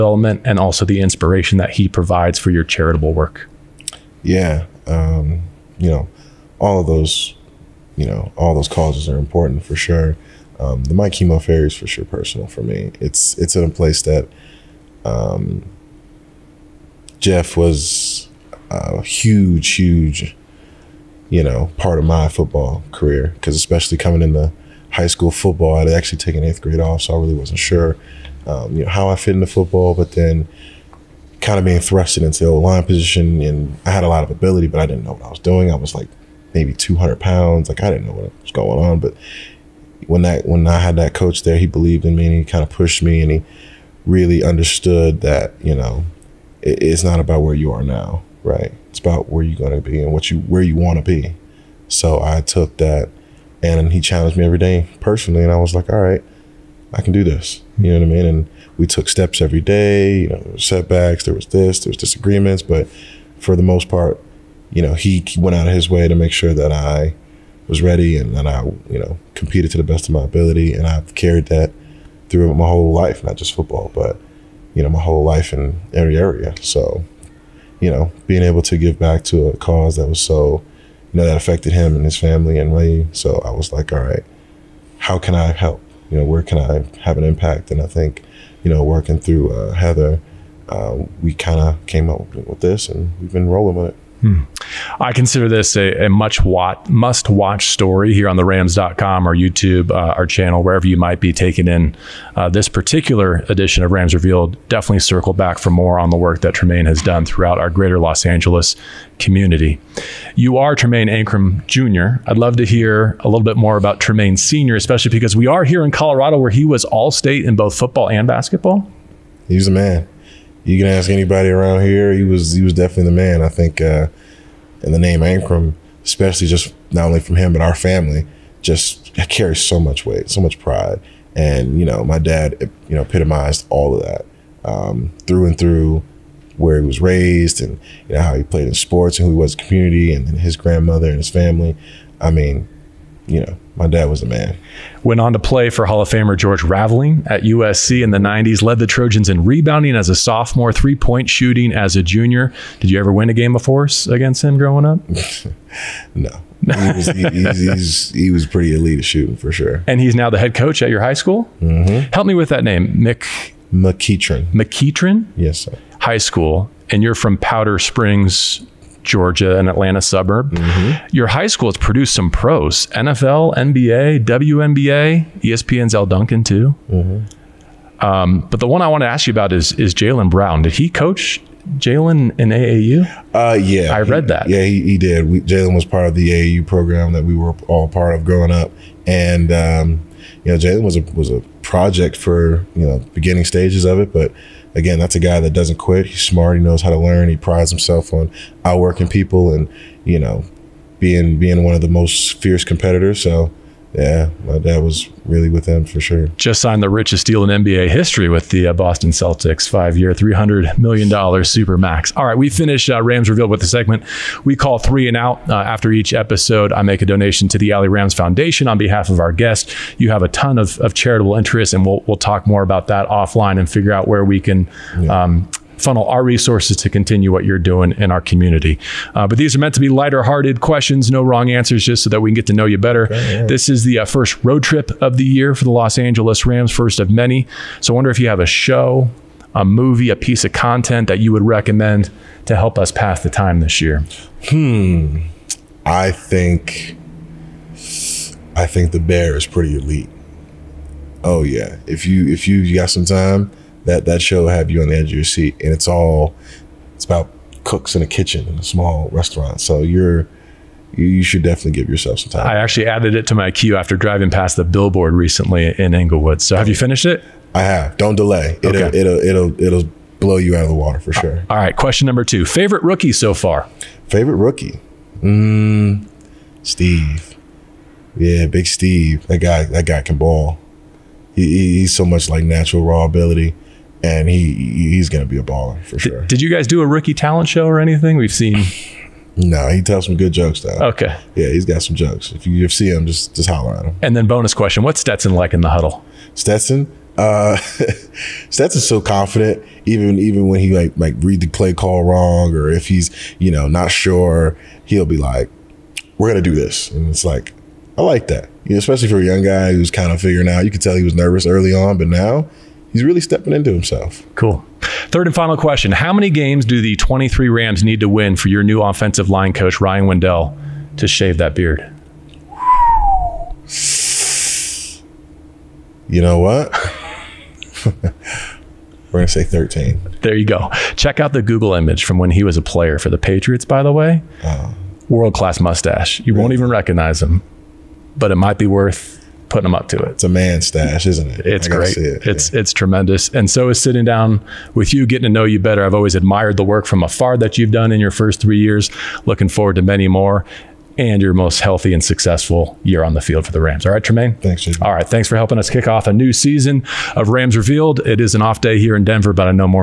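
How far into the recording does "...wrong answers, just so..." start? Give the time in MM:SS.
03:51.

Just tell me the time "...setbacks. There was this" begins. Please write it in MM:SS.
01:00.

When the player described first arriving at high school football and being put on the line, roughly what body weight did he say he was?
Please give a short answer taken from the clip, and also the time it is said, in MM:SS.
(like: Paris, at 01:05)
200 pounds, at 00:36.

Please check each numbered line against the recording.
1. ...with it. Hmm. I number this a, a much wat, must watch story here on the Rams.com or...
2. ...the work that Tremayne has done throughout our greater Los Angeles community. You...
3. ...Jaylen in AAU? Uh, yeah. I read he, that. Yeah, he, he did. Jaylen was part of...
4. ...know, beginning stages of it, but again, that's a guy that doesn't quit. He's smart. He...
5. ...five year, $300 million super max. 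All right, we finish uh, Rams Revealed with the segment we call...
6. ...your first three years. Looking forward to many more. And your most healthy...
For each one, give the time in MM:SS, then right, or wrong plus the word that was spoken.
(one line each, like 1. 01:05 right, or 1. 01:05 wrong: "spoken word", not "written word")
1. 01:33 wrong: "consider", not "number"
2. 01:46 right
3. 03:01 right
4. 03:12 right
5. 03:29 right
6. 05:47 right.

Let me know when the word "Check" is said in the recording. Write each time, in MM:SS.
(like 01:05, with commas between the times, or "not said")
05:30.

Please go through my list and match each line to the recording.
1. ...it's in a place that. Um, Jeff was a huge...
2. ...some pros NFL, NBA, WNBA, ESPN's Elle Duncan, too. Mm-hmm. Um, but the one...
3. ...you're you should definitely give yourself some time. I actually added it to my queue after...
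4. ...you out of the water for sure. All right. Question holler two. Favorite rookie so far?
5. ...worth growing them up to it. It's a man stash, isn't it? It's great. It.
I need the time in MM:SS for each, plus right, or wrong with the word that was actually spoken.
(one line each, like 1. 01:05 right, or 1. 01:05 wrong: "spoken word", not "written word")
1. 00:13 right
2. 02:52 right
3. 04:19 right
4. 04:30 wrong: "number", not "holler"
5. 05:38 wrong: "putting", not "growing".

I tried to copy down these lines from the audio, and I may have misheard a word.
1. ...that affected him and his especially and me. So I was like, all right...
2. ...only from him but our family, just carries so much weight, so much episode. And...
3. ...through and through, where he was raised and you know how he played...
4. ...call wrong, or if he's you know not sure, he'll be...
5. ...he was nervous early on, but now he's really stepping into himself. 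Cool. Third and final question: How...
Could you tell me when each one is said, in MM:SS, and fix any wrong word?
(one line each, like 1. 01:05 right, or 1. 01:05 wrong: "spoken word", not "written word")
1. 01:21 wrong: "family", not "especially"
2. 02:07 wrong: "pride", not "episode"
3. 02:15 right
4. 05:01 right
5. 05:10 right.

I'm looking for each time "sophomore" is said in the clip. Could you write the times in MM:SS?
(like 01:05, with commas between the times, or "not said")
02:30.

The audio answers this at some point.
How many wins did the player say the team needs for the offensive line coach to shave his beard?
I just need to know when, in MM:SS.
05:29.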